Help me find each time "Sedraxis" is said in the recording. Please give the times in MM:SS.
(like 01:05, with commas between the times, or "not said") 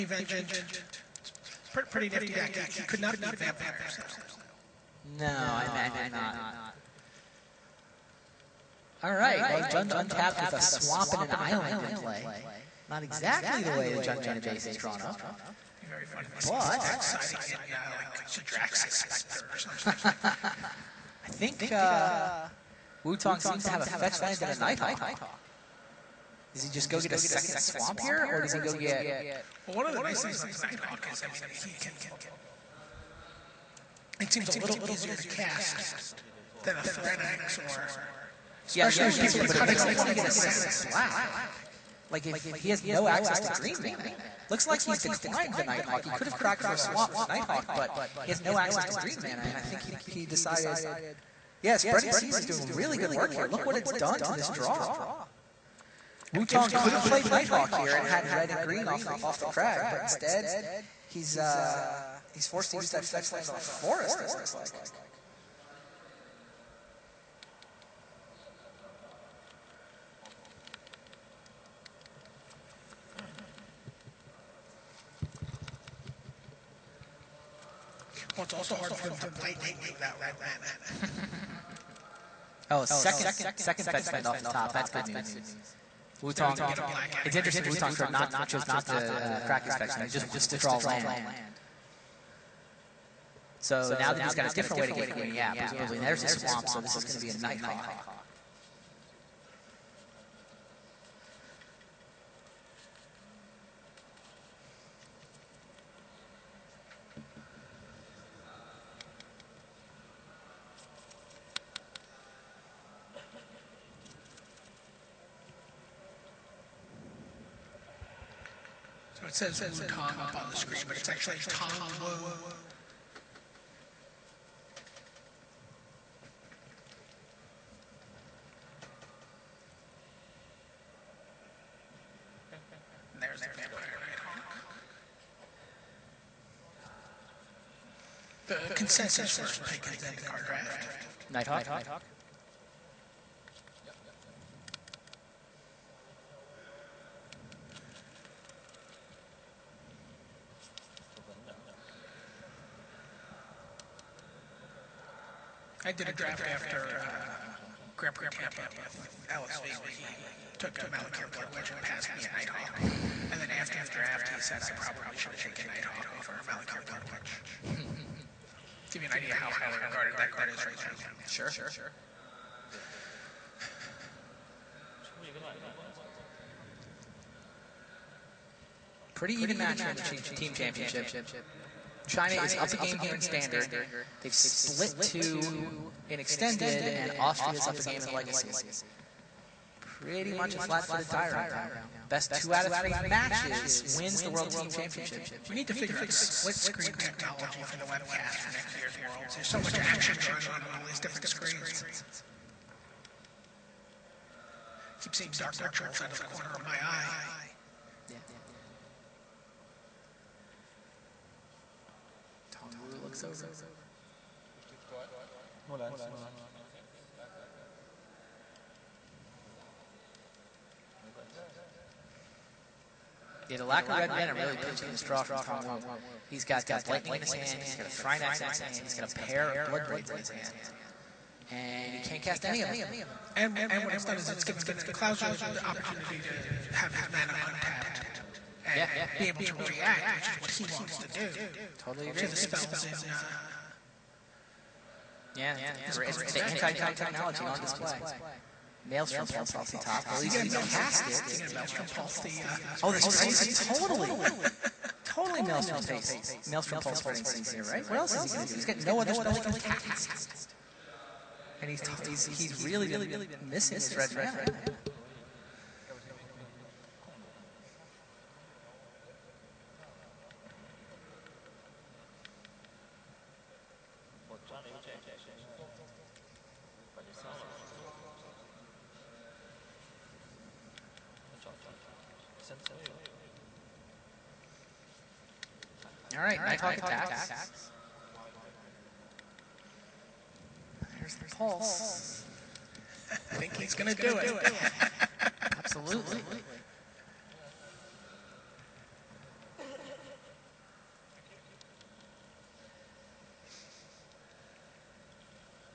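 00:18.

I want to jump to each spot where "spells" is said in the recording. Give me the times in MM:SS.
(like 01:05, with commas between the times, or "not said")
04:02, 04:19.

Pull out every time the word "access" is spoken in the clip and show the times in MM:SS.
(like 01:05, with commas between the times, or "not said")
00:43, 00:48.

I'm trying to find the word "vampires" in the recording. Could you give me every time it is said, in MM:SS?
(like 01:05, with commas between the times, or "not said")
00:03, 02:13.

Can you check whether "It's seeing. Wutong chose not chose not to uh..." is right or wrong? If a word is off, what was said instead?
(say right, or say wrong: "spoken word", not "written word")
wrong: "interesting", not "seeing".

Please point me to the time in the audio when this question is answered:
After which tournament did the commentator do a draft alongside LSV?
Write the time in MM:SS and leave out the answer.
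02:37.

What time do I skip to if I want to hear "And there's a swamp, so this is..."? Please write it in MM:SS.
01:35.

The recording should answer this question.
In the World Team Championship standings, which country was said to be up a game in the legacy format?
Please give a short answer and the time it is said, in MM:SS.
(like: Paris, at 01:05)
Austria, at 03:07.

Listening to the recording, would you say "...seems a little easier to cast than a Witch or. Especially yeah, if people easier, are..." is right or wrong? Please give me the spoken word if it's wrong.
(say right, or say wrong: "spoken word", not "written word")
wrong: "Thrynax", not "Witch".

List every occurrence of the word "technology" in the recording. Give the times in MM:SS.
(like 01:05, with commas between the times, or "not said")
03:16, 04:06.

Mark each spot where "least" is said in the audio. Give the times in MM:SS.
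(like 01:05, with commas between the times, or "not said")
04:10.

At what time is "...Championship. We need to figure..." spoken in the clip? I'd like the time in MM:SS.
03:14.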